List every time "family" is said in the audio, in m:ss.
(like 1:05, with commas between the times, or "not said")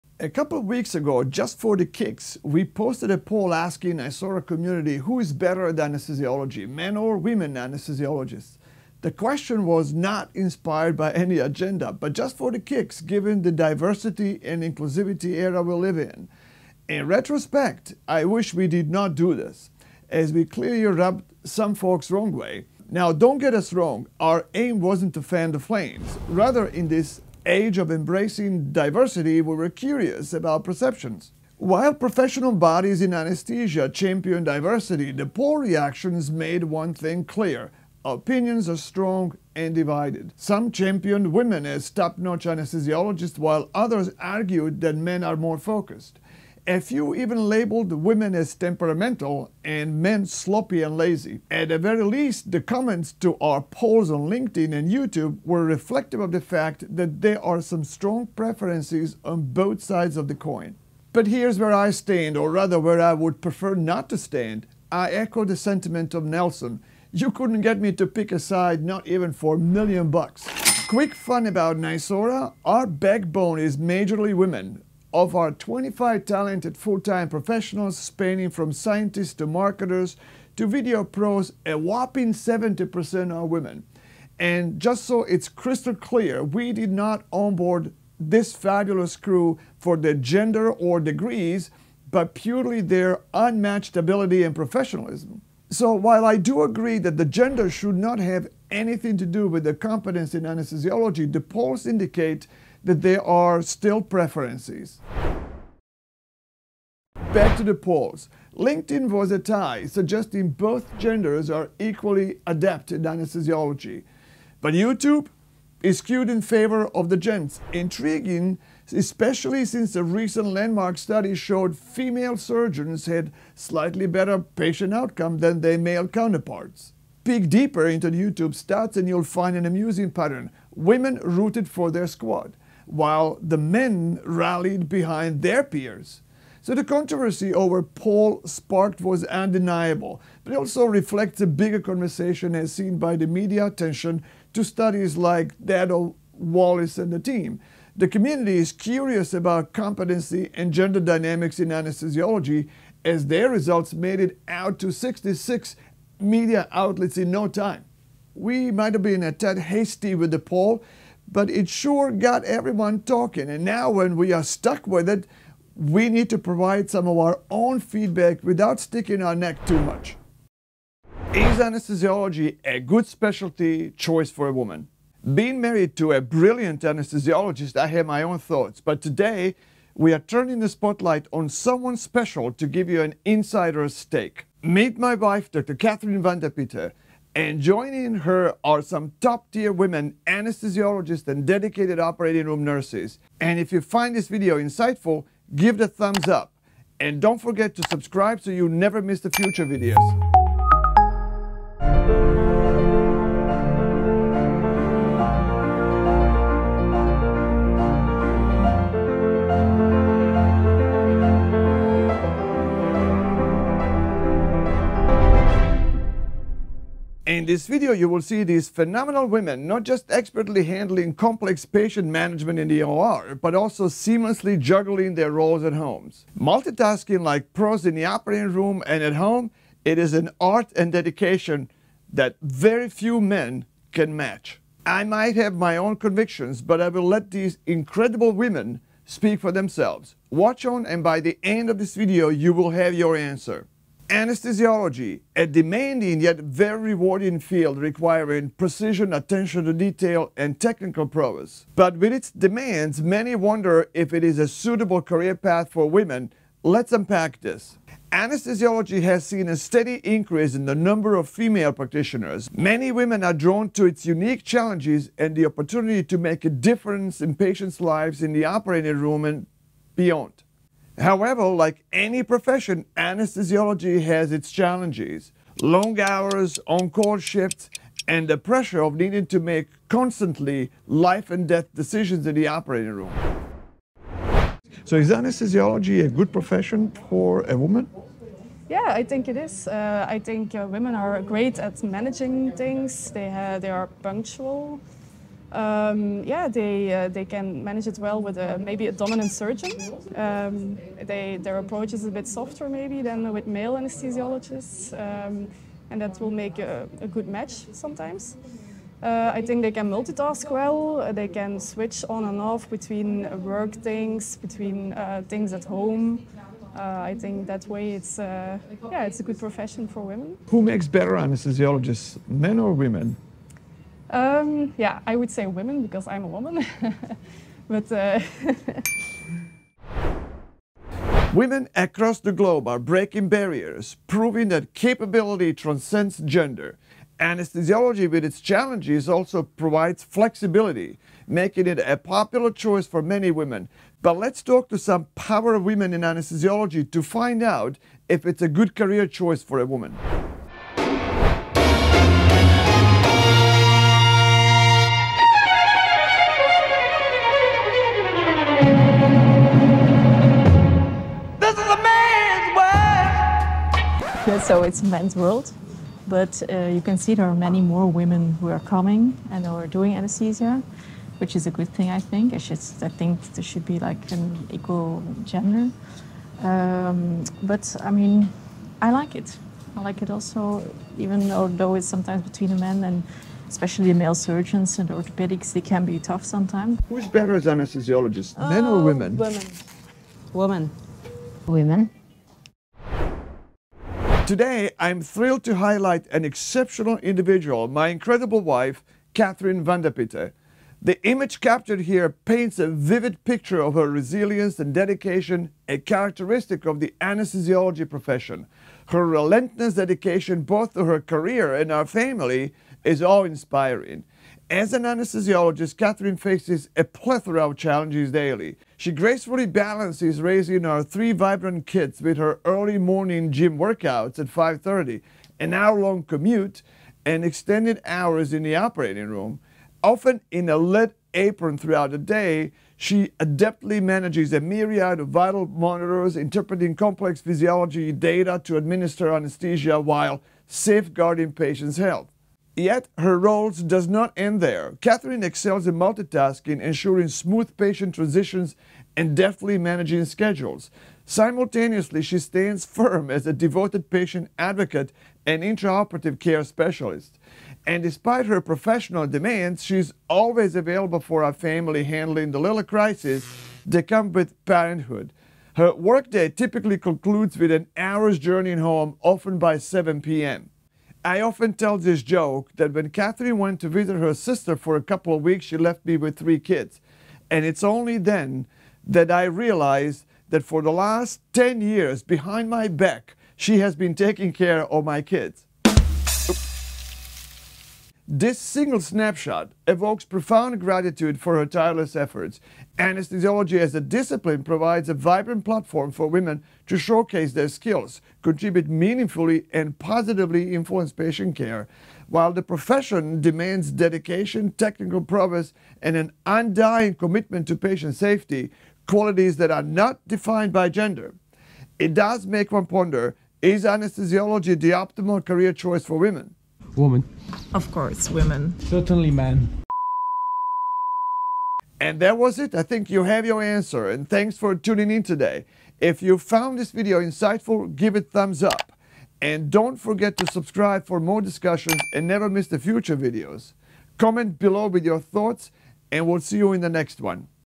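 6:51, 7:41.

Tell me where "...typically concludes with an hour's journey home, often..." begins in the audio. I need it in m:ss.
7:46.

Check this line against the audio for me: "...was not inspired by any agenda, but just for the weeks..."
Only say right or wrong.
wrong.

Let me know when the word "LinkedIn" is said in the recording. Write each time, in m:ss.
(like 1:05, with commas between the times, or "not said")
0:54, 1:48.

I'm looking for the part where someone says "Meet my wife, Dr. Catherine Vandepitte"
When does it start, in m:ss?
3:04.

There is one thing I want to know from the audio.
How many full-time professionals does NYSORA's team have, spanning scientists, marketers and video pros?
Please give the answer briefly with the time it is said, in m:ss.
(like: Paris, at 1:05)
25, at 1:15.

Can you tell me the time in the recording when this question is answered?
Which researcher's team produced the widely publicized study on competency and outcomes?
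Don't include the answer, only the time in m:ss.
2:26.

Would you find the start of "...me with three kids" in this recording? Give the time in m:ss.
7:55.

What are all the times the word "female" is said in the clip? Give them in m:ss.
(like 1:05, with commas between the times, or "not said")
2:01, 4:21.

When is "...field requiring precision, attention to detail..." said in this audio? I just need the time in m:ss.
4:07.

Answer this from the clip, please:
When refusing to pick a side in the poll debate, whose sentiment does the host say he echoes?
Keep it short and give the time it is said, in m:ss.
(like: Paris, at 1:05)
Nelson, at 1:06.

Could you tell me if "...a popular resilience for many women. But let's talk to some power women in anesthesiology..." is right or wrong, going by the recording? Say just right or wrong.
wrong.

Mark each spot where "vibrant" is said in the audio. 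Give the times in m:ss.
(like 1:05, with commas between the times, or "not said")
7:01, 8:14.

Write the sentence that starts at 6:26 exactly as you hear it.
Who's better as anesthesiologist, men or oh, women?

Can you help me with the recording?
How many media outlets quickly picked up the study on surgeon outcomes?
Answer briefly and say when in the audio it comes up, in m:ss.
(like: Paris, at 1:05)
66, at 2:34.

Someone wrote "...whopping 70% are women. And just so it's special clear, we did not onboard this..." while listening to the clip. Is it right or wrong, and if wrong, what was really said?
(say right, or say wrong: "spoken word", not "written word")
wrong: "crystal", not "special".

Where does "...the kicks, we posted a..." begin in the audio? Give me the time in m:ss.
0:01.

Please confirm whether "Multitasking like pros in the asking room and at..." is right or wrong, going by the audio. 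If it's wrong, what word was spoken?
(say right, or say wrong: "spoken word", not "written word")
wrong: "operating", not "asking".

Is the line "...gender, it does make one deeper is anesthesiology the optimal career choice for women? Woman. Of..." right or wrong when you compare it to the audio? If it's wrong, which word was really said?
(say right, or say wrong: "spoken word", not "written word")
wrong: "ponder", not "deeper".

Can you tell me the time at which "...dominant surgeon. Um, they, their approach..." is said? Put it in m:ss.
4:58.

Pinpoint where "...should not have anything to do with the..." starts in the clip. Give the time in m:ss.
1:37.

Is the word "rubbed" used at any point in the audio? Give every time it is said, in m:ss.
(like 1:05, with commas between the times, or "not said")
0:20.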